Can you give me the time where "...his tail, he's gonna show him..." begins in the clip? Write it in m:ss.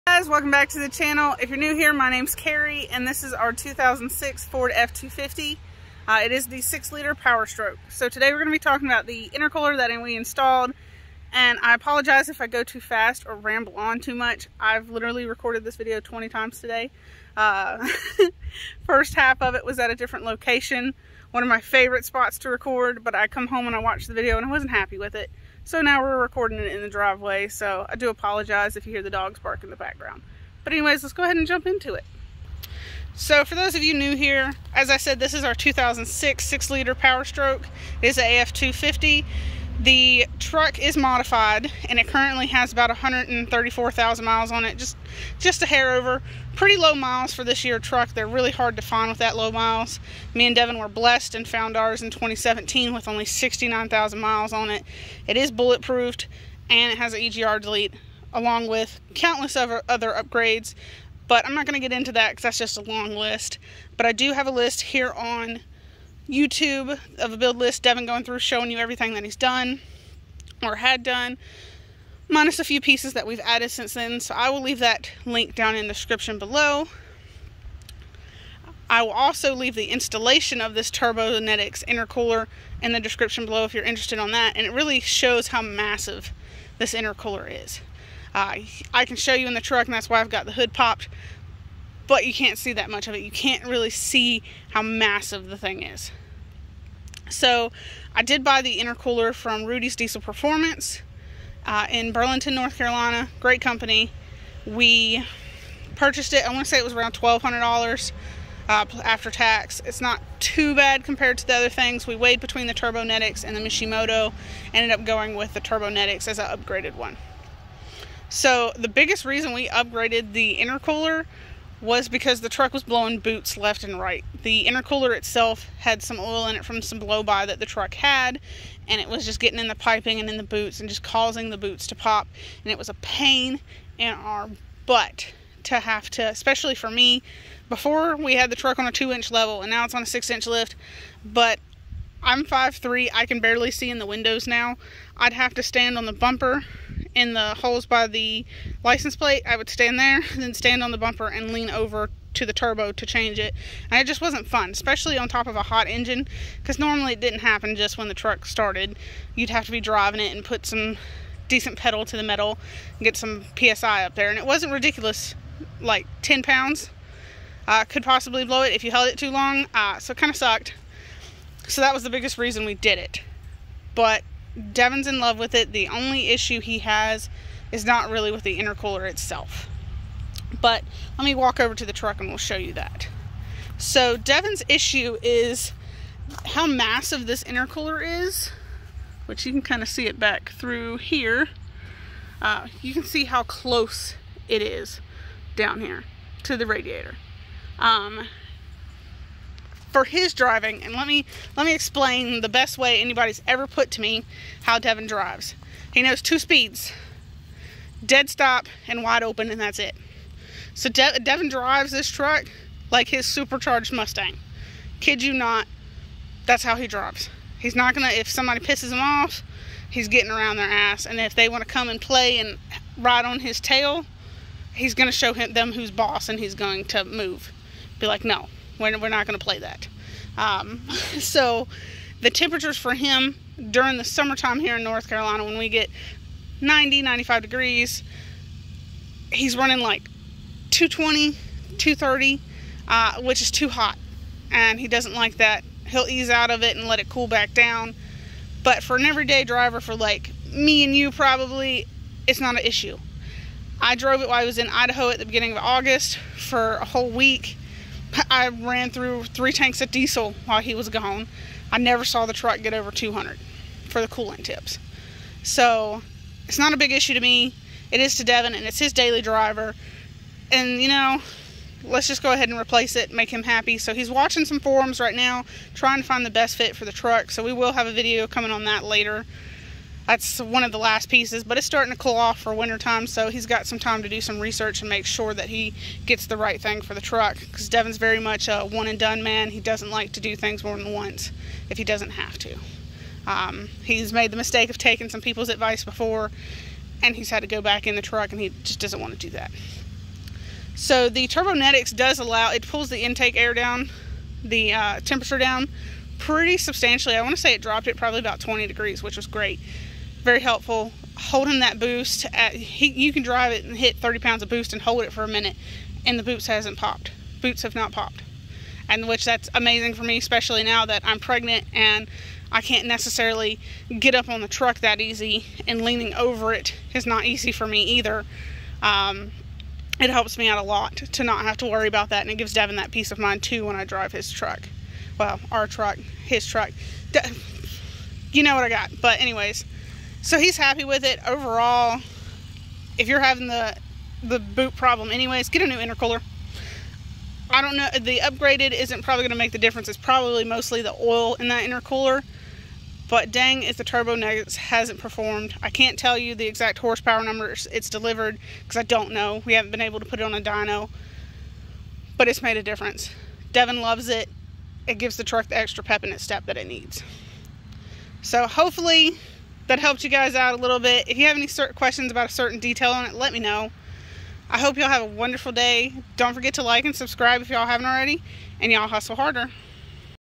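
3:43.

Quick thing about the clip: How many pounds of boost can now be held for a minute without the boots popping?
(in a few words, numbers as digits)
30 pounds.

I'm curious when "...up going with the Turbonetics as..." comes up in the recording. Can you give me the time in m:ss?
1:54.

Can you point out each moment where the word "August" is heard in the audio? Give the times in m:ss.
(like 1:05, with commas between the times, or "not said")
4:15.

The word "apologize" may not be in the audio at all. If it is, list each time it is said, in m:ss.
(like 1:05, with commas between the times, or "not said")
0:11, 0:28.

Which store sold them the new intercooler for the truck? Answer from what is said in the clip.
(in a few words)
Rudy's Diesel Performance.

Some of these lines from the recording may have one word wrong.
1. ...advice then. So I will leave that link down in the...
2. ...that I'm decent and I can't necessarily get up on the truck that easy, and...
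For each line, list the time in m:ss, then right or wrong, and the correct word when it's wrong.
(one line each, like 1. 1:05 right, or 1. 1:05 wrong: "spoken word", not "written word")
1. 1:13 wrong: "since", not "advice"
2. 5:20 wrong: "pregnant", not "decent".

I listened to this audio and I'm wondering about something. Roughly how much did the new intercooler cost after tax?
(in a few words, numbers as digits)
$1,200.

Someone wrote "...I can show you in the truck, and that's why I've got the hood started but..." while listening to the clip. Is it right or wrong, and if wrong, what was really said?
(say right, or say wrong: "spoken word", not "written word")
wrong: "popped", not "started".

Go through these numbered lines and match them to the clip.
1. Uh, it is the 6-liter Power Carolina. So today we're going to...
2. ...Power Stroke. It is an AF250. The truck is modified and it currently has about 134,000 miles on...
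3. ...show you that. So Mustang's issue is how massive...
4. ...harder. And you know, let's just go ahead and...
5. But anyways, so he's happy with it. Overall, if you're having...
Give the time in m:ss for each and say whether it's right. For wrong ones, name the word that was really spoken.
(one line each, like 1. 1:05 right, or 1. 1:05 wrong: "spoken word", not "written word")
1. 0:06 wrong: "Stroke", not "Carolina"
2. 0:36 right
3. 3:02 wrong: "Devin", not "Mustang"
4. 4:29 wrong: "driver", not "harder"
5. 5:39 right.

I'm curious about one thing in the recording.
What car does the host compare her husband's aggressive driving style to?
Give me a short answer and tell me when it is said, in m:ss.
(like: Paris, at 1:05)
supercharged Mustang, at 3:33.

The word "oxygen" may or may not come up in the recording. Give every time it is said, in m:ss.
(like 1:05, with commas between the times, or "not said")
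not said.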